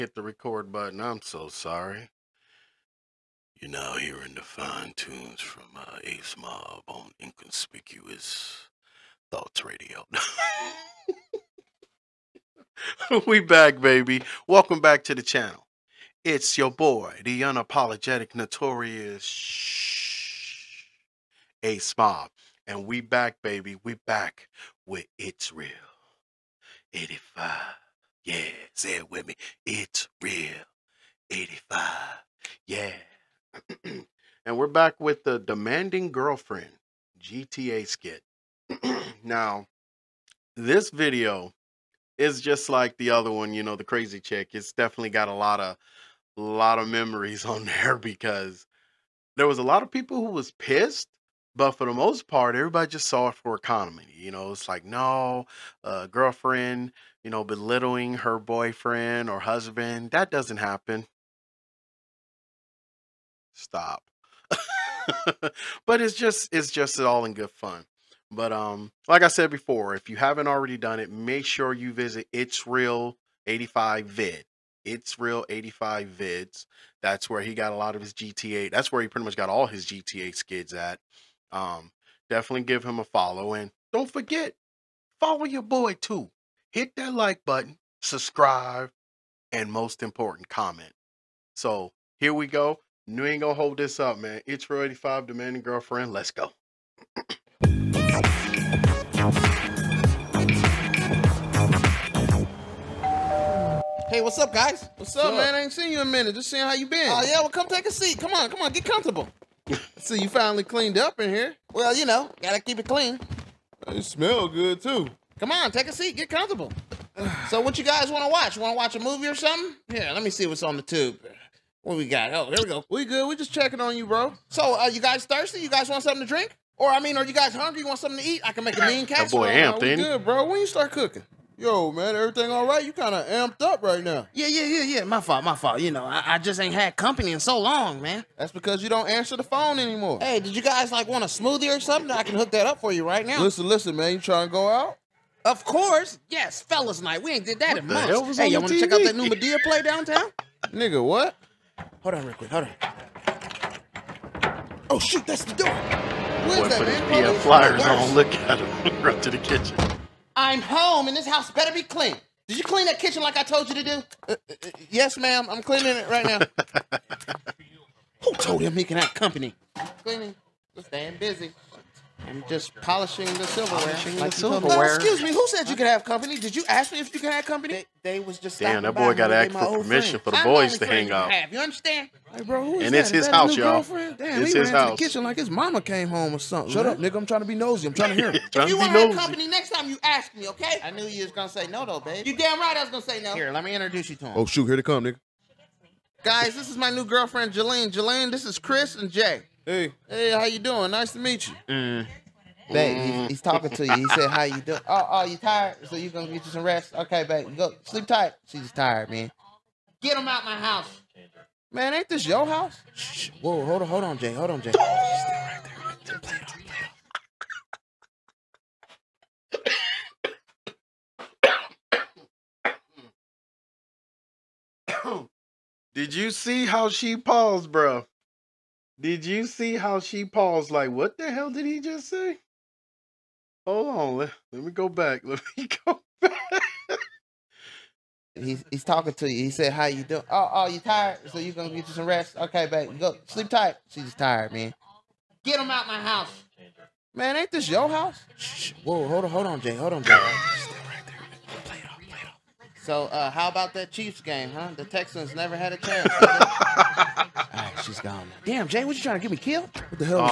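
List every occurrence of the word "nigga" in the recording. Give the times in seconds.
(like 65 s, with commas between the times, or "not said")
150 s, 186 s, 195 s.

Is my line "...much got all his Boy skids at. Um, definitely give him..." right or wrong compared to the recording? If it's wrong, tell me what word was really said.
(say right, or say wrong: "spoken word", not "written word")
wrong: "GTA", not "Boy".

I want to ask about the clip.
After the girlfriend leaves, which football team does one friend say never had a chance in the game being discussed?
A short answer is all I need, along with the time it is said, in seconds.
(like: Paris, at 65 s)
The Texans, at 254 s.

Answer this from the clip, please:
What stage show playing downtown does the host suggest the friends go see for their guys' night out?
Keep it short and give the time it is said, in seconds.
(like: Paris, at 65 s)
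Madea play, at 149 s.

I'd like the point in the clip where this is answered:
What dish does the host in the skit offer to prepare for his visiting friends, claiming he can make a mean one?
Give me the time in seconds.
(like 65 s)
129 s.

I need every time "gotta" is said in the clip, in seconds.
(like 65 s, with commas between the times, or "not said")
112 s.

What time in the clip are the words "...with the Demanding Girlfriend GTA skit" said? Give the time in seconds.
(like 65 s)
34 s.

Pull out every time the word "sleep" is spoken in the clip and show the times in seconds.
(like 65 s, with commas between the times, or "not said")
207 s, 243 s.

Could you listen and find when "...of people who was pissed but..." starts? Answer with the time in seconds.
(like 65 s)
49 s.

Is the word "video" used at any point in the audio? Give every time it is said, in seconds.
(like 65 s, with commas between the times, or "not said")
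40 s.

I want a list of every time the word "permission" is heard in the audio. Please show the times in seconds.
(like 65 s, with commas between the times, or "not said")
179 s.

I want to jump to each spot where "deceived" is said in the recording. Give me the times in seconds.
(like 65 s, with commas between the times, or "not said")
not said.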